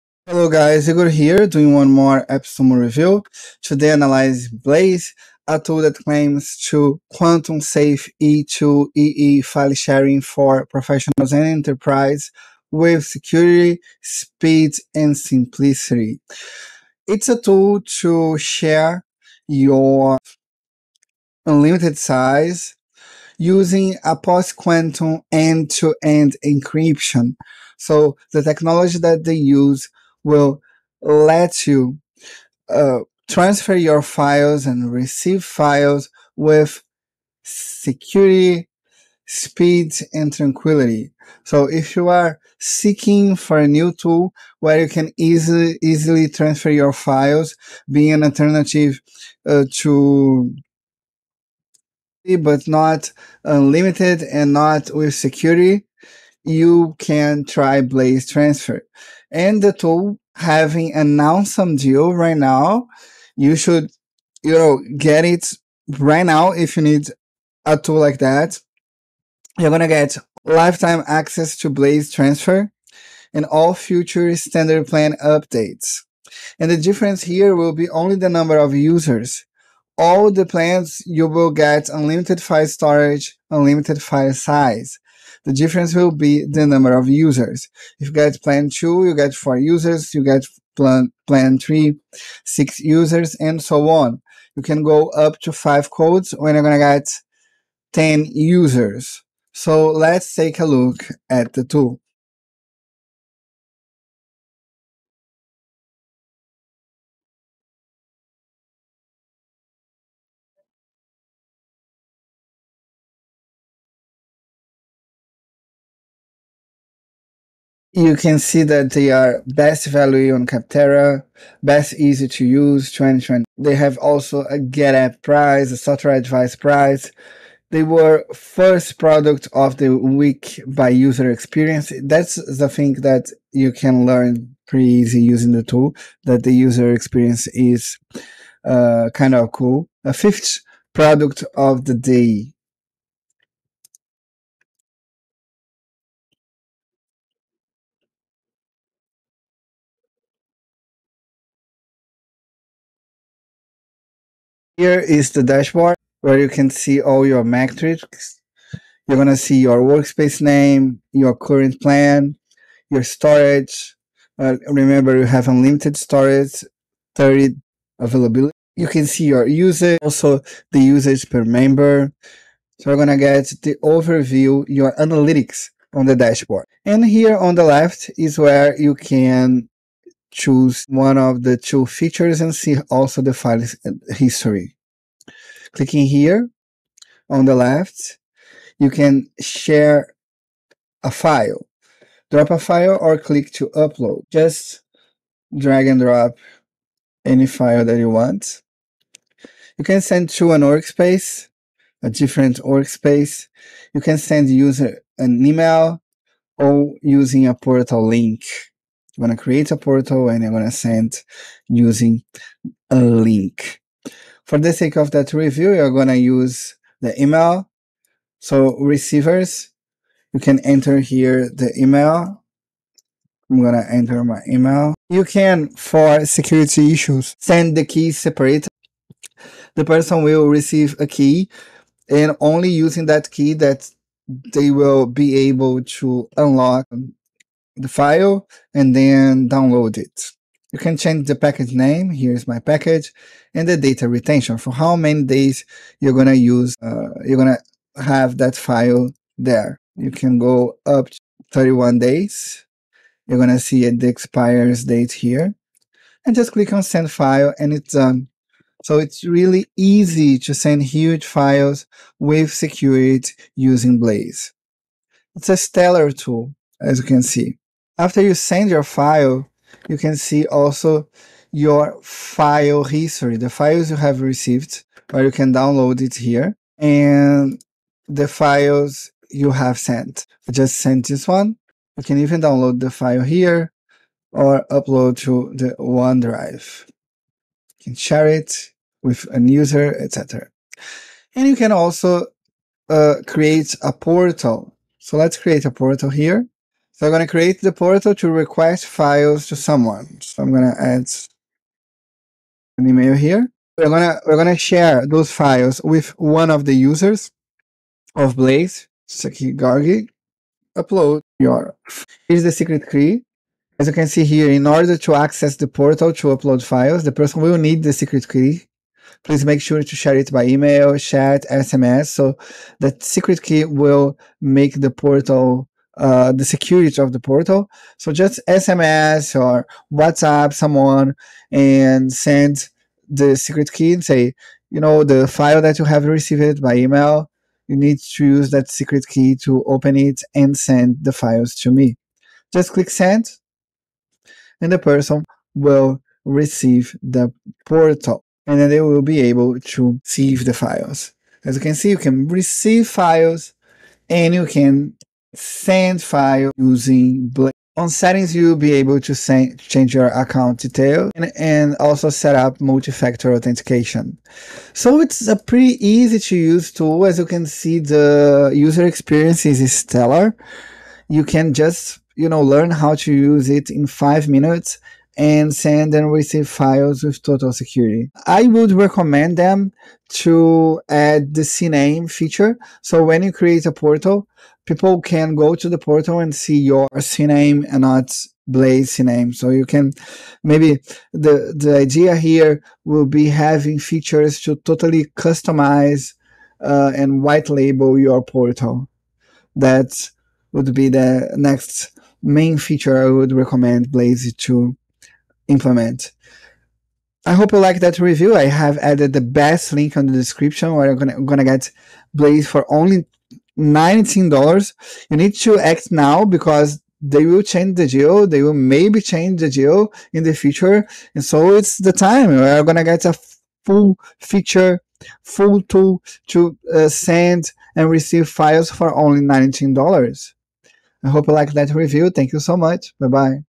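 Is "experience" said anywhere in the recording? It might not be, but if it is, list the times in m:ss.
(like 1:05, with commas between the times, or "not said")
2:11, 2:16, 6:08.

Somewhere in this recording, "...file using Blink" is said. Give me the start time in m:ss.
5:56.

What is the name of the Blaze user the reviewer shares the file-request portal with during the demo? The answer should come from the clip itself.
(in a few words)
Gargi.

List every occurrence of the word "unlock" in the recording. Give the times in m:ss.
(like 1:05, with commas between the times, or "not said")
3:56.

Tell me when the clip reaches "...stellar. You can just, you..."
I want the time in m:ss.
6:09.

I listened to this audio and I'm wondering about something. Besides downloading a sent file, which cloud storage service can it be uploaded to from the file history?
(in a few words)
OneDrive.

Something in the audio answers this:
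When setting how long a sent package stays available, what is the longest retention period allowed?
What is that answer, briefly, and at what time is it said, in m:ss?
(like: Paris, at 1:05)
31 days, at 4:11.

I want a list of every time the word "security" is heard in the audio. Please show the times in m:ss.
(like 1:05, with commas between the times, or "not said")
0:13, 0:37, 0:55, 3:46, 4:22, 5:26, 6:17.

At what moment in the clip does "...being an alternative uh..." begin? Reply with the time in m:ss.
0:47.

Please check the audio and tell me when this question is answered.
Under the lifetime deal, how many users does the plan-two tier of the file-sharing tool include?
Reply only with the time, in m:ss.
1:29.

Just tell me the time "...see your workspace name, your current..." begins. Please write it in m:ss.
2:39.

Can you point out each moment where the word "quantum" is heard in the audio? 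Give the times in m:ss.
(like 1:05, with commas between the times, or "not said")
0:07, 0:24.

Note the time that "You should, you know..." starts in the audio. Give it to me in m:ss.
1:03.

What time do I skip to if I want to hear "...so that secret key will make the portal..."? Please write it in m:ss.
5:22.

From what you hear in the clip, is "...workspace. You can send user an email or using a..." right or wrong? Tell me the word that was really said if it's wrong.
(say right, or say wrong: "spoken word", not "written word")
right.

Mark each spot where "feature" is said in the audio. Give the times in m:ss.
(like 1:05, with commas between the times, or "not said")
3:01, 6:22, 6:33, 6:42, 7:04.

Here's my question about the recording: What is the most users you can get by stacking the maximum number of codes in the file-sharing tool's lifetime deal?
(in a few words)
10.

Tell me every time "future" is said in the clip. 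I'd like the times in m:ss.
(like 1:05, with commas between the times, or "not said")
1:13, 7:00.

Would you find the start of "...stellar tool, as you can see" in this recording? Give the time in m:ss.
4:25.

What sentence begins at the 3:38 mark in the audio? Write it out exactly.
So receivers, you can enter here the email.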